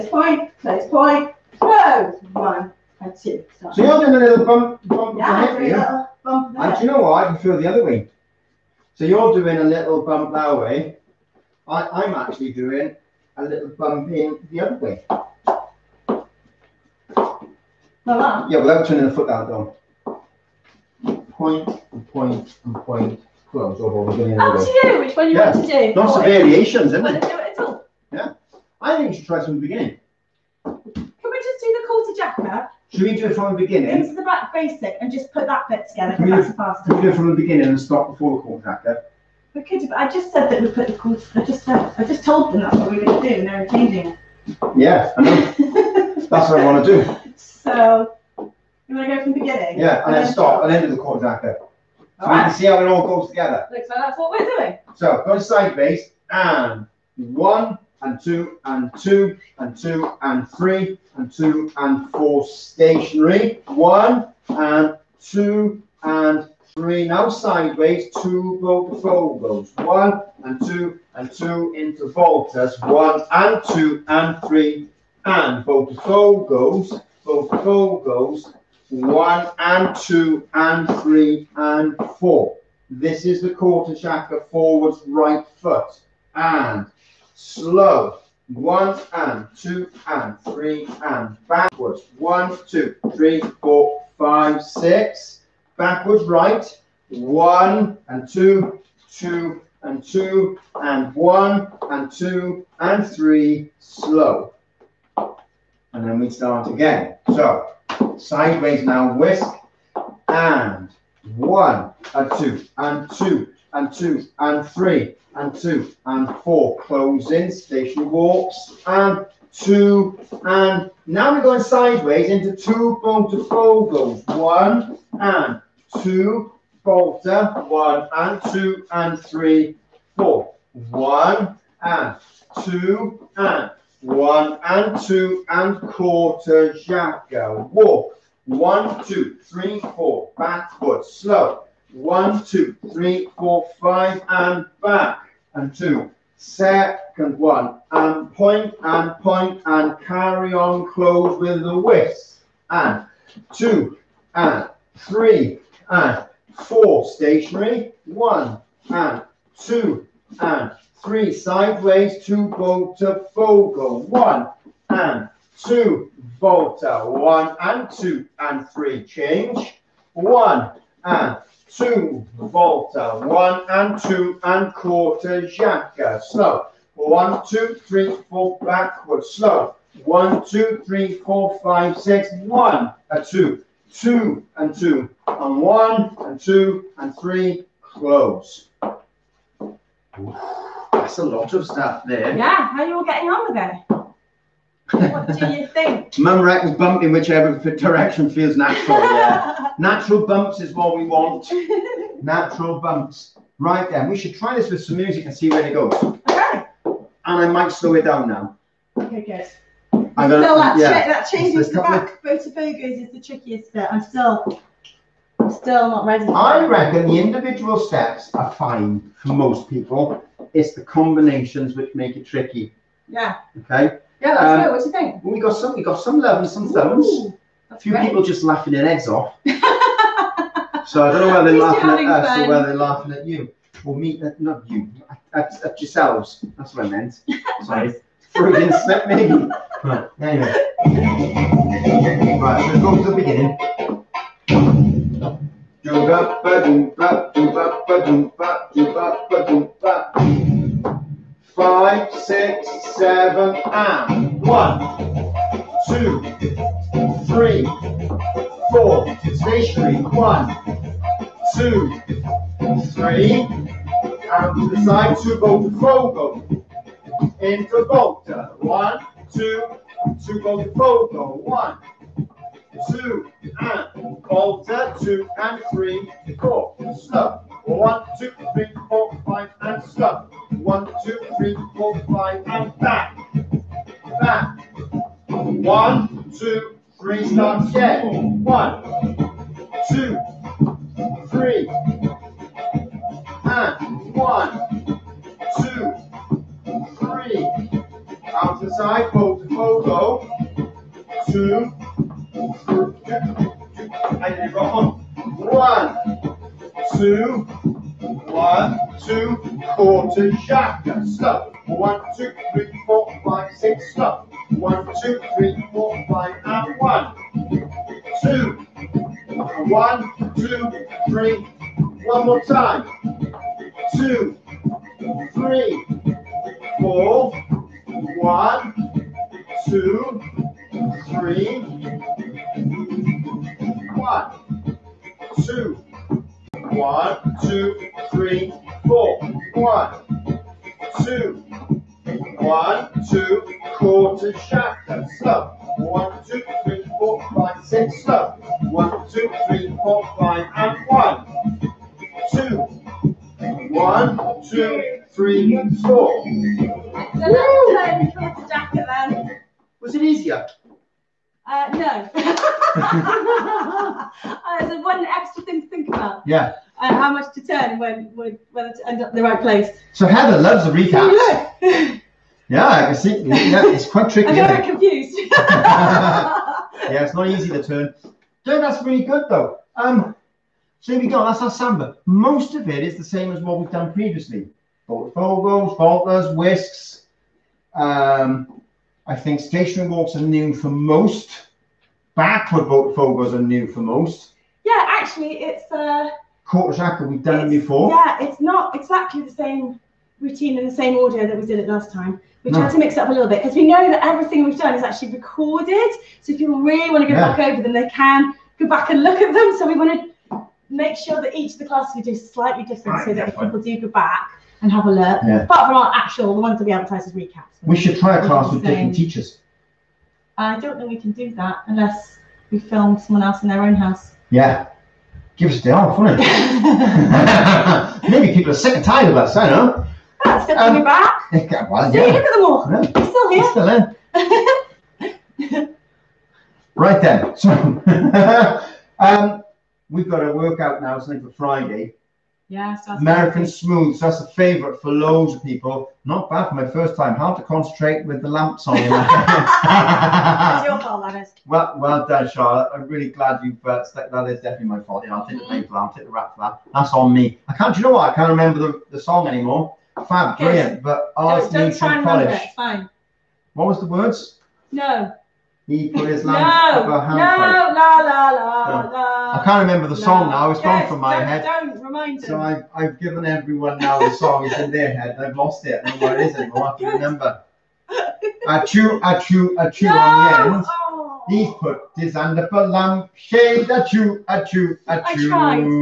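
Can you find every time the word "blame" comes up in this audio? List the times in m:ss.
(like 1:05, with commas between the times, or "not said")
7:35.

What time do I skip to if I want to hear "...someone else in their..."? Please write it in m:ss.
7:02.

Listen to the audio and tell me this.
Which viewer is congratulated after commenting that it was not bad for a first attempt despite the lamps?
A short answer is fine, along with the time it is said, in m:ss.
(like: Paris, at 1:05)
Charlotte, at 7:32.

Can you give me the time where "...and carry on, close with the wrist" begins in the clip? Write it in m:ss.
2:29.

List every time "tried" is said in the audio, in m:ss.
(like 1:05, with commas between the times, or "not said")
6:42, 8:05.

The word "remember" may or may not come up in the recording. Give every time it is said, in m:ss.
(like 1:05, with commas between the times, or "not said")
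7:38, 7:49, 7:56.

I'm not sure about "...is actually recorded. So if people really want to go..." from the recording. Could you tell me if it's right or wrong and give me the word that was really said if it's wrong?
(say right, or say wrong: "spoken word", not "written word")
right.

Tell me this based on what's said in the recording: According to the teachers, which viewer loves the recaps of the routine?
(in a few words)
Heather.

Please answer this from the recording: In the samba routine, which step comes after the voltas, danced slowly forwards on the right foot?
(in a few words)
corta jaca forwards.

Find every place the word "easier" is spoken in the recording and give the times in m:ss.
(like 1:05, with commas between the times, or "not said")
6:00.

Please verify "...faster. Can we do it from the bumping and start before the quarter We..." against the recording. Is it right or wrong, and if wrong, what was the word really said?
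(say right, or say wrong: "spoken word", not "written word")
wrong: "beginning", not "bumping".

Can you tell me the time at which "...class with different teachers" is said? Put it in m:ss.
6:58.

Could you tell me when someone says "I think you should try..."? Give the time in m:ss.
0:28.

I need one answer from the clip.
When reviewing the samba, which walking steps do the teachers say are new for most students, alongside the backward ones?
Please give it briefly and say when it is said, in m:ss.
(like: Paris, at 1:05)
stationary walks, at 6:29.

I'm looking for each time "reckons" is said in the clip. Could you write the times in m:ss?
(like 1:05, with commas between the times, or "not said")
3:16, 3:36.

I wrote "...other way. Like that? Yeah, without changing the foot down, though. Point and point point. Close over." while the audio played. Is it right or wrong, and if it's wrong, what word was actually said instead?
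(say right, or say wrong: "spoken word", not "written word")
wrong: "turning", not "changing".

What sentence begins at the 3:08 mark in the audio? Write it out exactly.
that's a lot of stuff there.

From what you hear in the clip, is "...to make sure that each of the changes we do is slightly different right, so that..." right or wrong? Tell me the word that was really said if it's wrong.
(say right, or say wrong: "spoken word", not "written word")
wrong: "classes", not "changes".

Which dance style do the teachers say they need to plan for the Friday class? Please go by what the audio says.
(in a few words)
American smooth.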